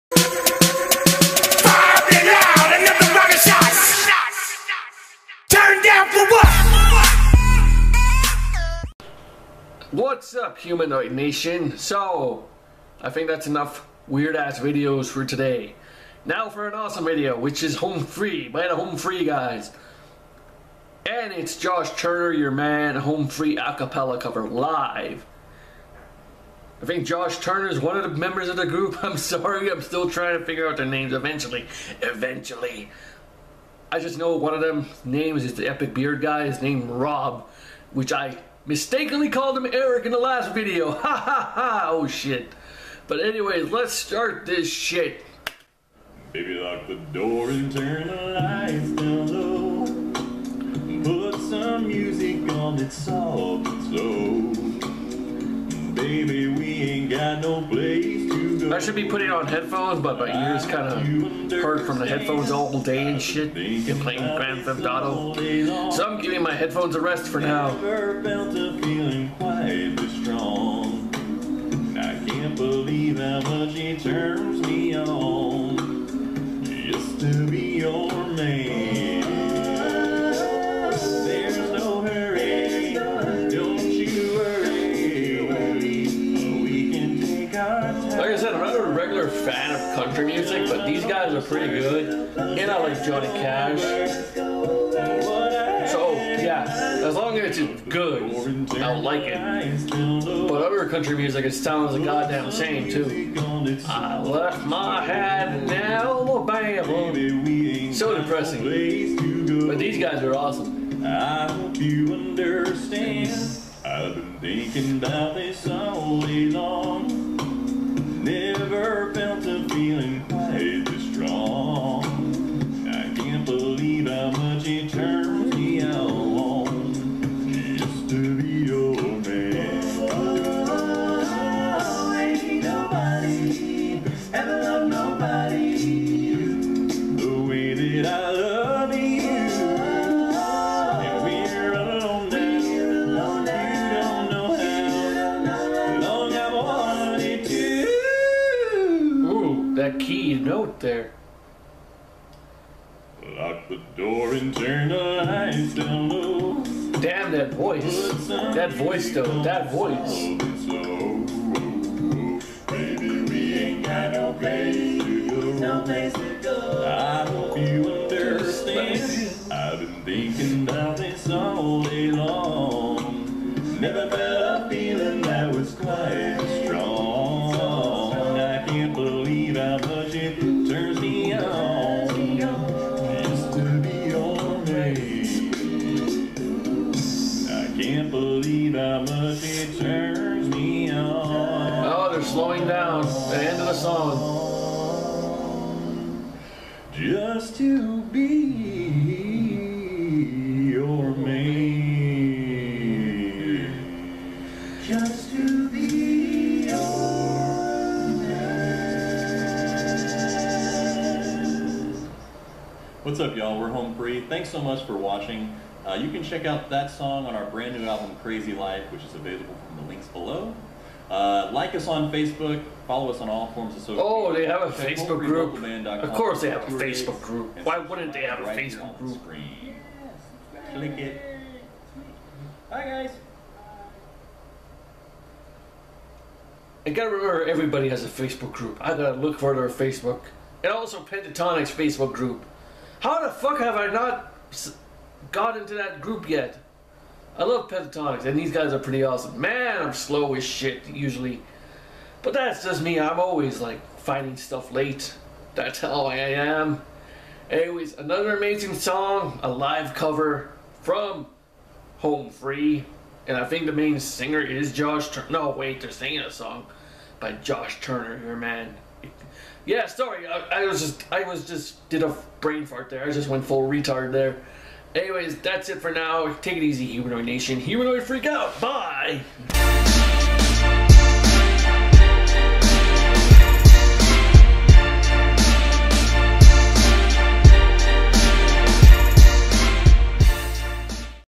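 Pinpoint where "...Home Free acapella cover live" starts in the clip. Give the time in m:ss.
0:22.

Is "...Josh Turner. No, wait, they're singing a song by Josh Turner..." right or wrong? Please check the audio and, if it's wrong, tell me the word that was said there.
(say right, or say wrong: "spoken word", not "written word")
right.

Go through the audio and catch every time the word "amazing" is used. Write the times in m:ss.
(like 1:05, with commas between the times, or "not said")
4:18.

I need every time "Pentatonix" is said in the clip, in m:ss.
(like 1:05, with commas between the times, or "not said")
4:01, 4:07.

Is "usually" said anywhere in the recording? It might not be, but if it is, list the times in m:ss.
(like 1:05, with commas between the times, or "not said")
4:10.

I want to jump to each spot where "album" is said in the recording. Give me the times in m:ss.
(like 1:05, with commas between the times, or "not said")
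3:37.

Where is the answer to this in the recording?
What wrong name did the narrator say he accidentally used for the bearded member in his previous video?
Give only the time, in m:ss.
0:39.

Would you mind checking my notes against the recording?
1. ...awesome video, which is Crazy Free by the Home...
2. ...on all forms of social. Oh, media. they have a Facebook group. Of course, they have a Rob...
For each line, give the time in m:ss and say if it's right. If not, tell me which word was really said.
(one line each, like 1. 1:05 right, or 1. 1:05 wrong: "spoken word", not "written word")
1. 0:16 wrong: "Home", not "Crazy"
2. 3:43 wrong: "Facebook", not "Rob".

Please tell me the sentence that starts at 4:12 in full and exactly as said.
I'm always, like, finding stuff late.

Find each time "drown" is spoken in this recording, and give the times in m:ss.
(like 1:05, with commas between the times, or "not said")
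not said.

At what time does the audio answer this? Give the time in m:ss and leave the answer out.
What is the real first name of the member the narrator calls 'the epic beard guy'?
0:36.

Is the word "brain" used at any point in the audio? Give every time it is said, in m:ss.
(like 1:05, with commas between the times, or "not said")
4:32.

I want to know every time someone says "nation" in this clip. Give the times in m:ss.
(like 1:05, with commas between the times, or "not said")
0:11, 4:37.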